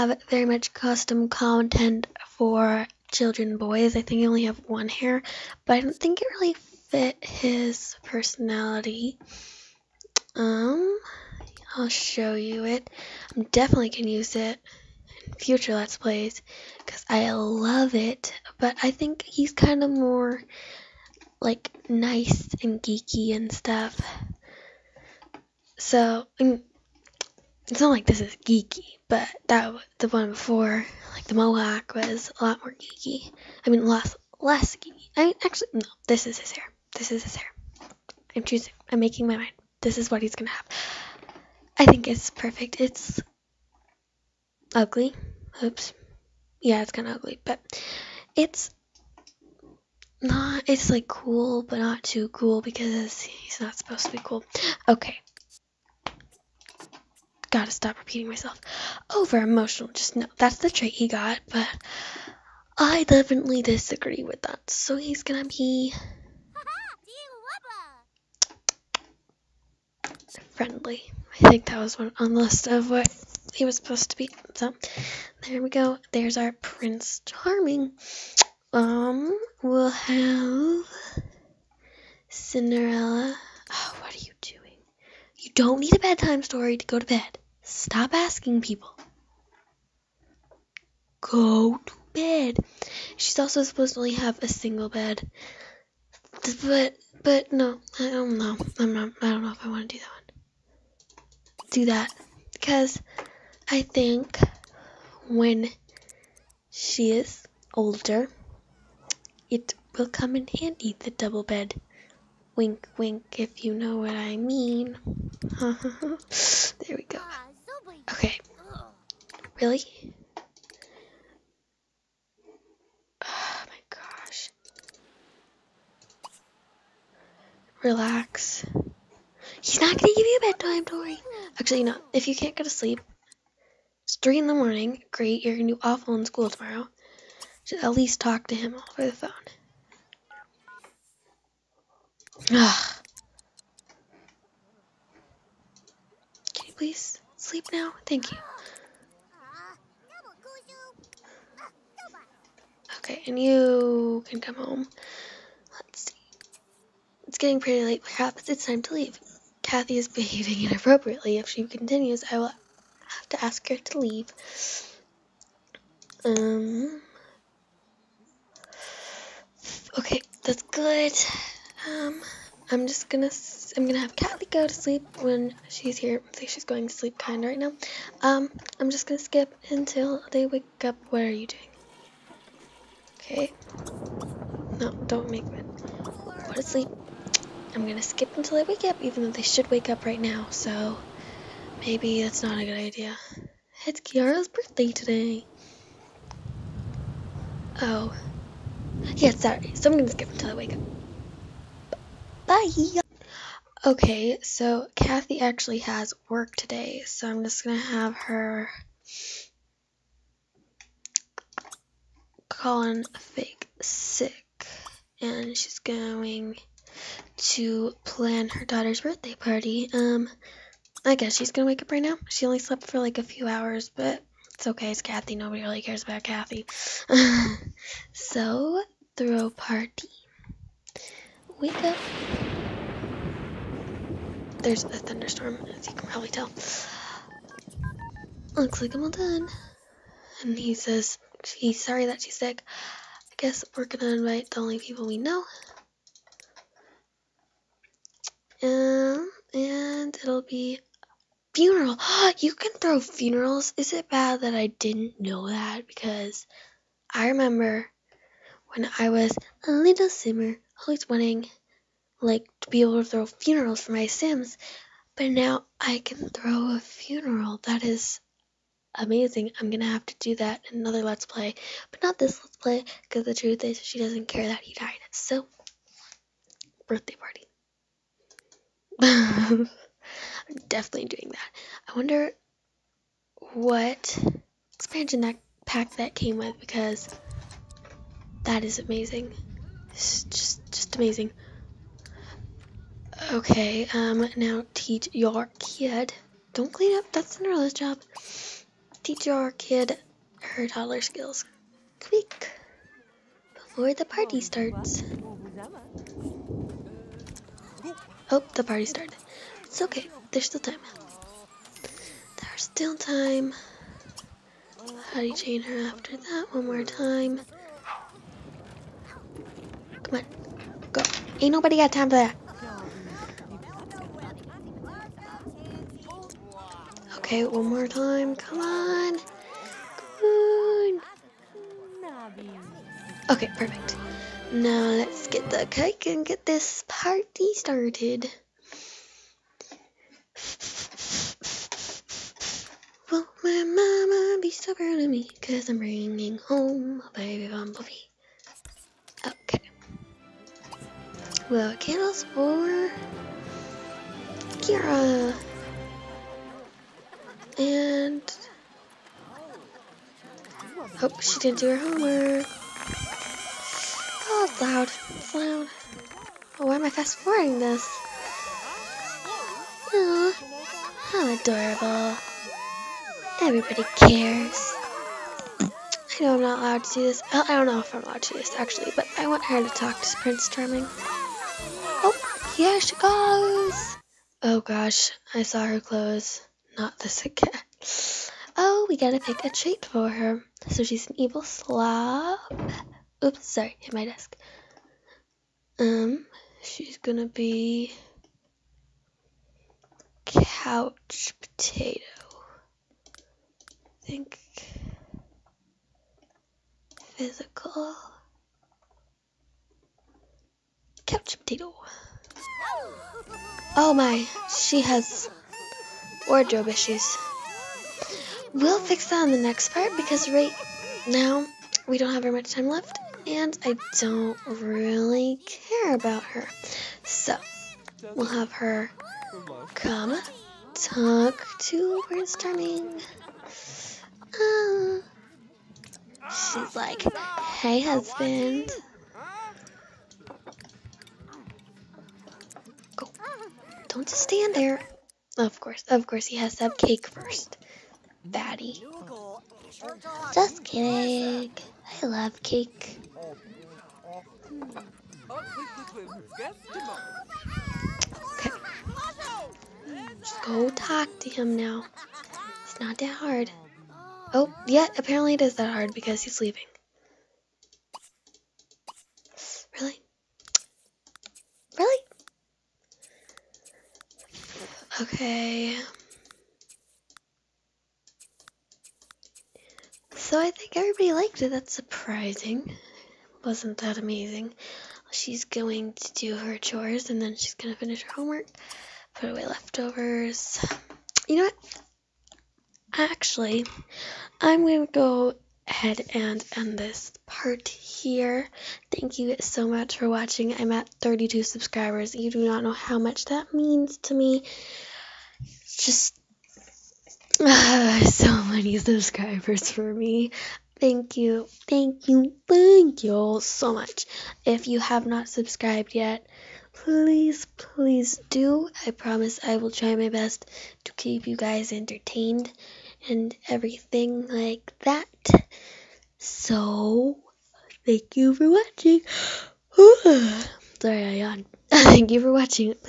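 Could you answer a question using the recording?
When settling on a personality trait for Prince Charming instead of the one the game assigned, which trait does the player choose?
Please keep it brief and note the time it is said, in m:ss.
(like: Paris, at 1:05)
Friendly, at 1:10.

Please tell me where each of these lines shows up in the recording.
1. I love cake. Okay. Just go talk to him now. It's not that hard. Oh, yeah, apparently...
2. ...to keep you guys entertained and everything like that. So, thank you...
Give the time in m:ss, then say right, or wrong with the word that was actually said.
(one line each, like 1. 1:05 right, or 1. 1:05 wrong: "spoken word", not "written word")
1. 7:32 right
2. 8:40 right.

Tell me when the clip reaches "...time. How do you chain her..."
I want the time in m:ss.
5:12.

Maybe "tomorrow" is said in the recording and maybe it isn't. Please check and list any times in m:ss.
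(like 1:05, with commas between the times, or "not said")
2:16.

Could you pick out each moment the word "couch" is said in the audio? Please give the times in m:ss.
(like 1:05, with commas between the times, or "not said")
6:40, 6:51.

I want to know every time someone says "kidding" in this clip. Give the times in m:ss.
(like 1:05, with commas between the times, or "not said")
7:30.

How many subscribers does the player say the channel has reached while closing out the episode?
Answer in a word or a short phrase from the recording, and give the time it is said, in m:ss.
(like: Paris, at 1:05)
32, at 8:21.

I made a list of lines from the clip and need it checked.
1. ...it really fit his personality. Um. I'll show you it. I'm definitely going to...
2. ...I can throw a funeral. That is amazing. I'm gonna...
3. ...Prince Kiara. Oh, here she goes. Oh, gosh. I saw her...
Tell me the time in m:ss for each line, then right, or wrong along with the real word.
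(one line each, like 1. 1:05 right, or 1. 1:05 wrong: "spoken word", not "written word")
1. 0:06 right
2. 4:25 right
3. 6:20 wrong: "Charming", not "Kiara".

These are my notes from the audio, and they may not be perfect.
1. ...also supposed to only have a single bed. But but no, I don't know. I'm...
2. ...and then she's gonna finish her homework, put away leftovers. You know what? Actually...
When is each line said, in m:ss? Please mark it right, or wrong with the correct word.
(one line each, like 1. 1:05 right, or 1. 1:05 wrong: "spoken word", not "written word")
1. 1:33 right
2. 8:07 right.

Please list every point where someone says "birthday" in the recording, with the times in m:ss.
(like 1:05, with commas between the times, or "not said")
3:14, 3:39, 4:36.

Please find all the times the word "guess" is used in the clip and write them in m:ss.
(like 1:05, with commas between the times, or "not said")
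3:41, 4:03.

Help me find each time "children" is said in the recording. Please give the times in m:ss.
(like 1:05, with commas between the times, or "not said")
0:03.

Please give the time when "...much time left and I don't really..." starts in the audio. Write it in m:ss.
7:02.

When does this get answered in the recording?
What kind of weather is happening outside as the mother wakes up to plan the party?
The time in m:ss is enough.
3:54.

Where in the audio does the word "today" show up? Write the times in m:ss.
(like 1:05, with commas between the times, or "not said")
3:14, 3:26.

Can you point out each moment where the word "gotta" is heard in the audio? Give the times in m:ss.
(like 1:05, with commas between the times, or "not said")
0:57, 6:28.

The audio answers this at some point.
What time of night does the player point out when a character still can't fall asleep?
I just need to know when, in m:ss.
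2:14.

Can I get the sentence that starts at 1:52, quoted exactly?
Wink, wink, if you know what I mean.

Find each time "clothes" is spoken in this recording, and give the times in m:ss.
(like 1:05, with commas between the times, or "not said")
6:25.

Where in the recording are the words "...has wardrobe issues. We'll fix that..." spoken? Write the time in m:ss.
6:54.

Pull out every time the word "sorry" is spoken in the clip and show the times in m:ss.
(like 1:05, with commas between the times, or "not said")
3:19, 4:01, 6:33, 8:50.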